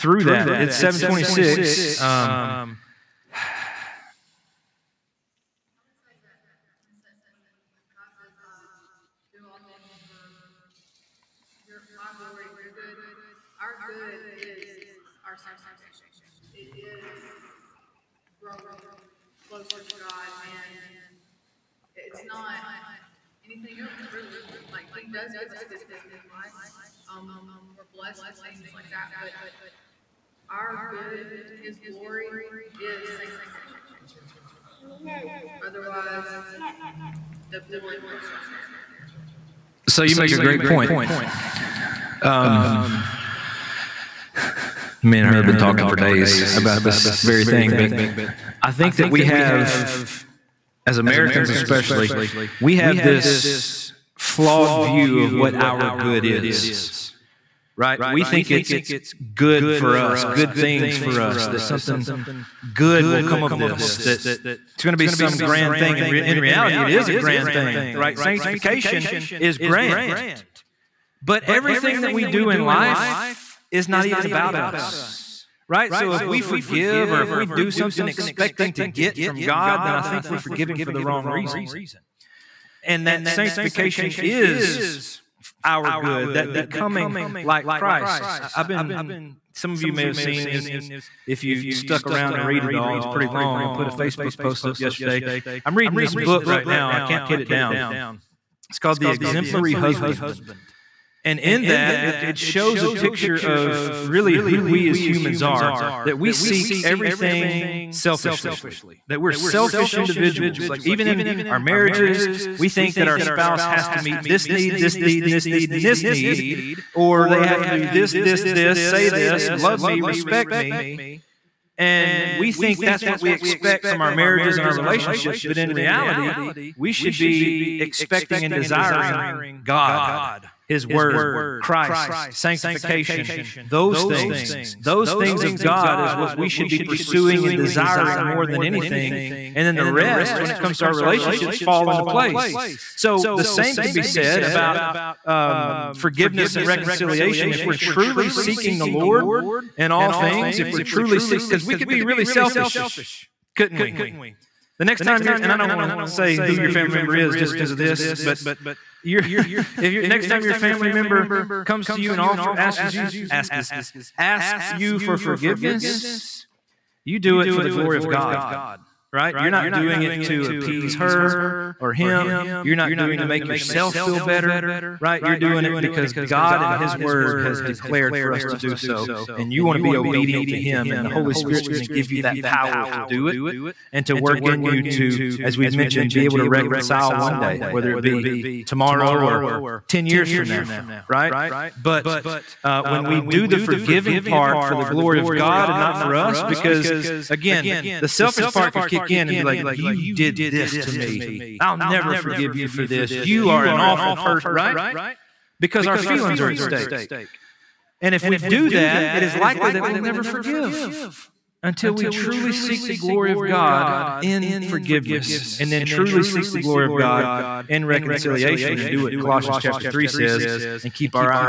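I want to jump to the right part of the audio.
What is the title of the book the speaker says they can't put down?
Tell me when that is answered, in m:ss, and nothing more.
1:38.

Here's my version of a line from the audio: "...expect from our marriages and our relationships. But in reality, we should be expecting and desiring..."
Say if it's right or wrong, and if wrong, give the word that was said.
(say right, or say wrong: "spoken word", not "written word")
right.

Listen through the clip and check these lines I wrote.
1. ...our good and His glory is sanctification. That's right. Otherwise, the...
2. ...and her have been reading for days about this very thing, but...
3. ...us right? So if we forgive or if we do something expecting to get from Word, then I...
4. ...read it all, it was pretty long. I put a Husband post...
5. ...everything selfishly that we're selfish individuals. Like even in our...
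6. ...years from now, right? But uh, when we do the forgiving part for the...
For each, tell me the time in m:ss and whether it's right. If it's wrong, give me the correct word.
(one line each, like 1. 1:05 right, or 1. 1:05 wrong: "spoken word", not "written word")
1. 0:30 right
2. 0:45 wrong: "talking", not "reading"
3. 1:14 wrong: "God", not "Word"
4. 1:32 wrong: "Facebook", not "Husband"
5. 1:46 right
6. 3:10 right.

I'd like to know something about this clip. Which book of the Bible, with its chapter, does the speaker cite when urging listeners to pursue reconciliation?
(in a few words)
Colossians 3.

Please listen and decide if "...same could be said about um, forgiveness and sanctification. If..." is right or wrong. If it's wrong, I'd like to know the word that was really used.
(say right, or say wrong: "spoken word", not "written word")
wrong: "reconciliation", not "sanctification".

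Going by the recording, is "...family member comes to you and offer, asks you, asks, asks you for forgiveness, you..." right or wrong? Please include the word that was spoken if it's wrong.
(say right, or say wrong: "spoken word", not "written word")
right.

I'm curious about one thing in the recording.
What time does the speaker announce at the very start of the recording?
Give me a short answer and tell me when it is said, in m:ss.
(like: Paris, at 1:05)
7:26, at 0:00.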